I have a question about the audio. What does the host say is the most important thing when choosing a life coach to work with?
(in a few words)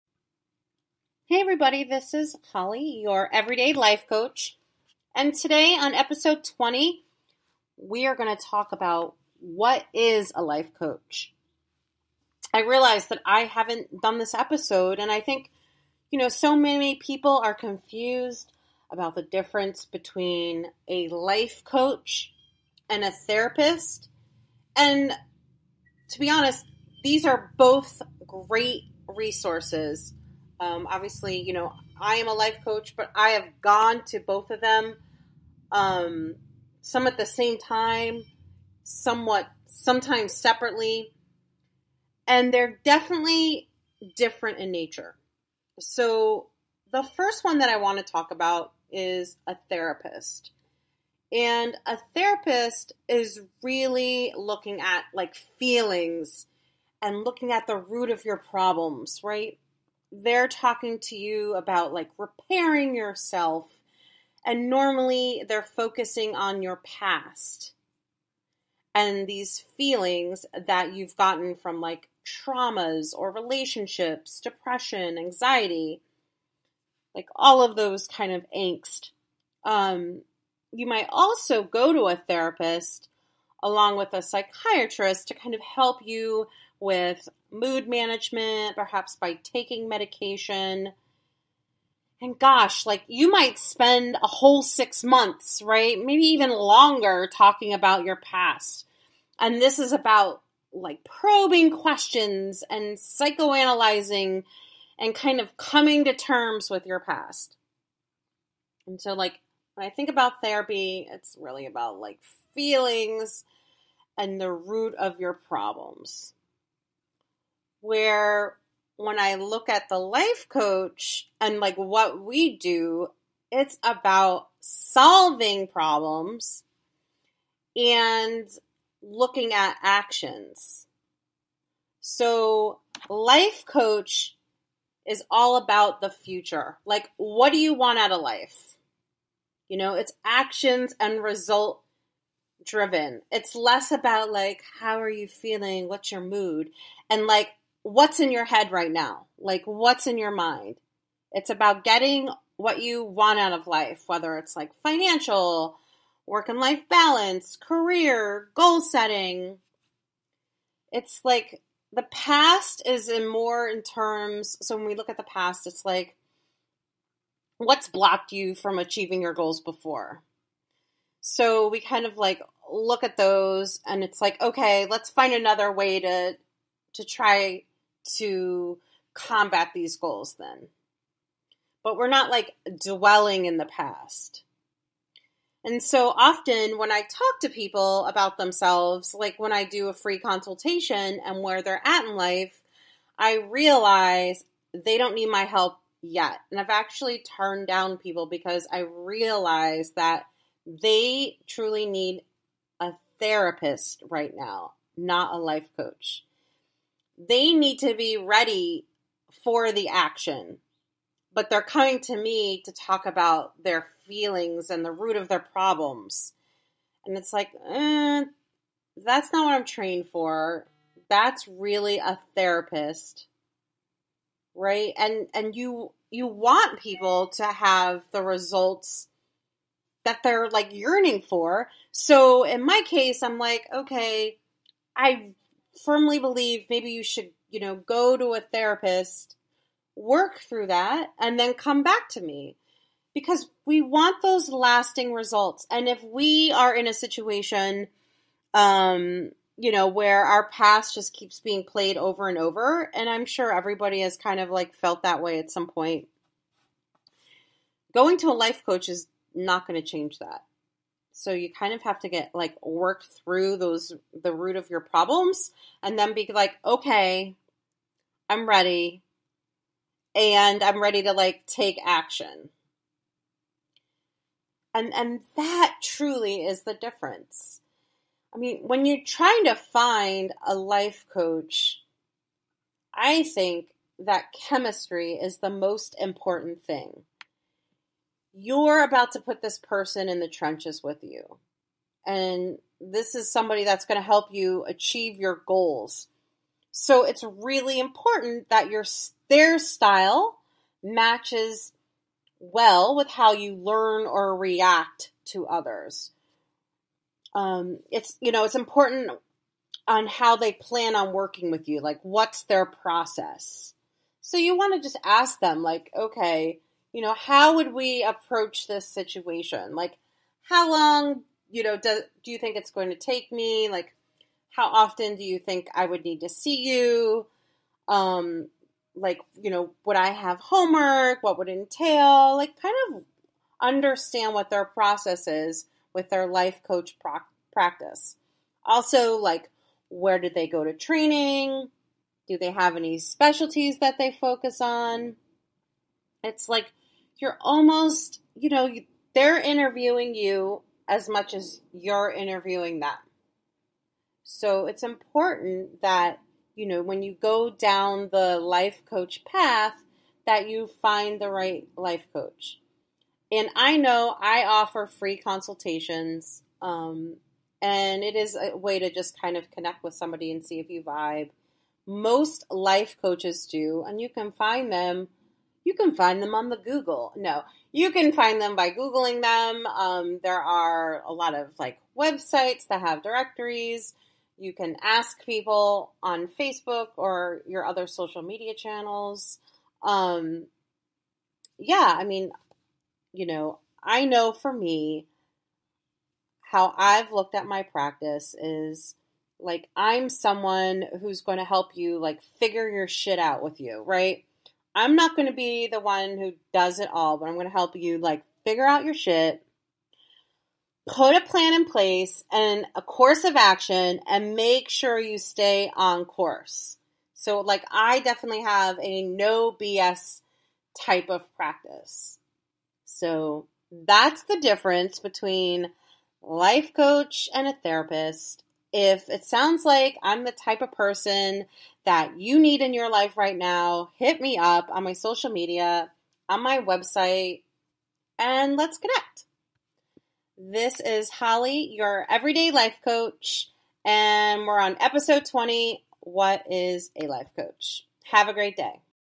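Chemistry.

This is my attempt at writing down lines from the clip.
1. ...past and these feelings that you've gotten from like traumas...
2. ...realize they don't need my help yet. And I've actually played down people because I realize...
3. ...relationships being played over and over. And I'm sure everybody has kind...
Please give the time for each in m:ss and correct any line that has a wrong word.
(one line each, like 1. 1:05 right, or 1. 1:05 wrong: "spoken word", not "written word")
1. 1:06 right
2. 3:13 wrong: "turned", not "played"
3. 4:11 wrong: "keeps", not "relationships".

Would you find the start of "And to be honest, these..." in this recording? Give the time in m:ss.
0:24.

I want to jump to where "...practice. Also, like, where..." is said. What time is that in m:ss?
5:37.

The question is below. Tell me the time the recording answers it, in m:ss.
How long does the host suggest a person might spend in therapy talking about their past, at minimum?
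1:34.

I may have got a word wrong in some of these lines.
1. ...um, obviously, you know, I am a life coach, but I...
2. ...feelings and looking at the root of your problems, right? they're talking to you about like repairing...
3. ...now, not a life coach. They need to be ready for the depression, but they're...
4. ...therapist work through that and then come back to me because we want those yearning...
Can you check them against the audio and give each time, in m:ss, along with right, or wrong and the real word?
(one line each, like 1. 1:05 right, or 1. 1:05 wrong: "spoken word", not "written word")
1. 0:30 right
2. 0:55 right
3. 3:24 wrong: "action", not "depression"
4. 3:58 wrong: "lasting", not "yearning".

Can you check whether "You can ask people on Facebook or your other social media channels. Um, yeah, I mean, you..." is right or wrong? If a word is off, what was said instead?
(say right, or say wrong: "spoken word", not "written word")
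right.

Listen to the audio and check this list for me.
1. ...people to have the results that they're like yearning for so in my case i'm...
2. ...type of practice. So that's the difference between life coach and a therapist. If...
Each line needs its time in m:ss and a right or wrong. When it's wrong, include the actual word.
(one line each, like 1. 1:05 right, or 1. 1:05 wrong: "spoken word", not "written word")
1. 3:46 right
2. 7:00 right.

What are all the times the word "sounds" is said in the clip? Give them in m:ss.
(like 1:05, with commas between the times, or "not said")
7:09.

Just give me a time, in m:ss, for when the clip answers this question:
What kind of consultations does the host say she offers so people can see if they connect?
6:04.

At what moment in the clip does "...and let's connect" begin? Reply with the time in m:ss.
7:18.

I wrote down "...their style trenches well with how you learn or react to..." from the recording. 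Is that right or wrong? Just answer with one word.
wrong.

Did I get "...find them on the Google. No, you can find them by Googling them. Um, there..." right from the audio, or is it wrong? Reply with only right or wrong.
right.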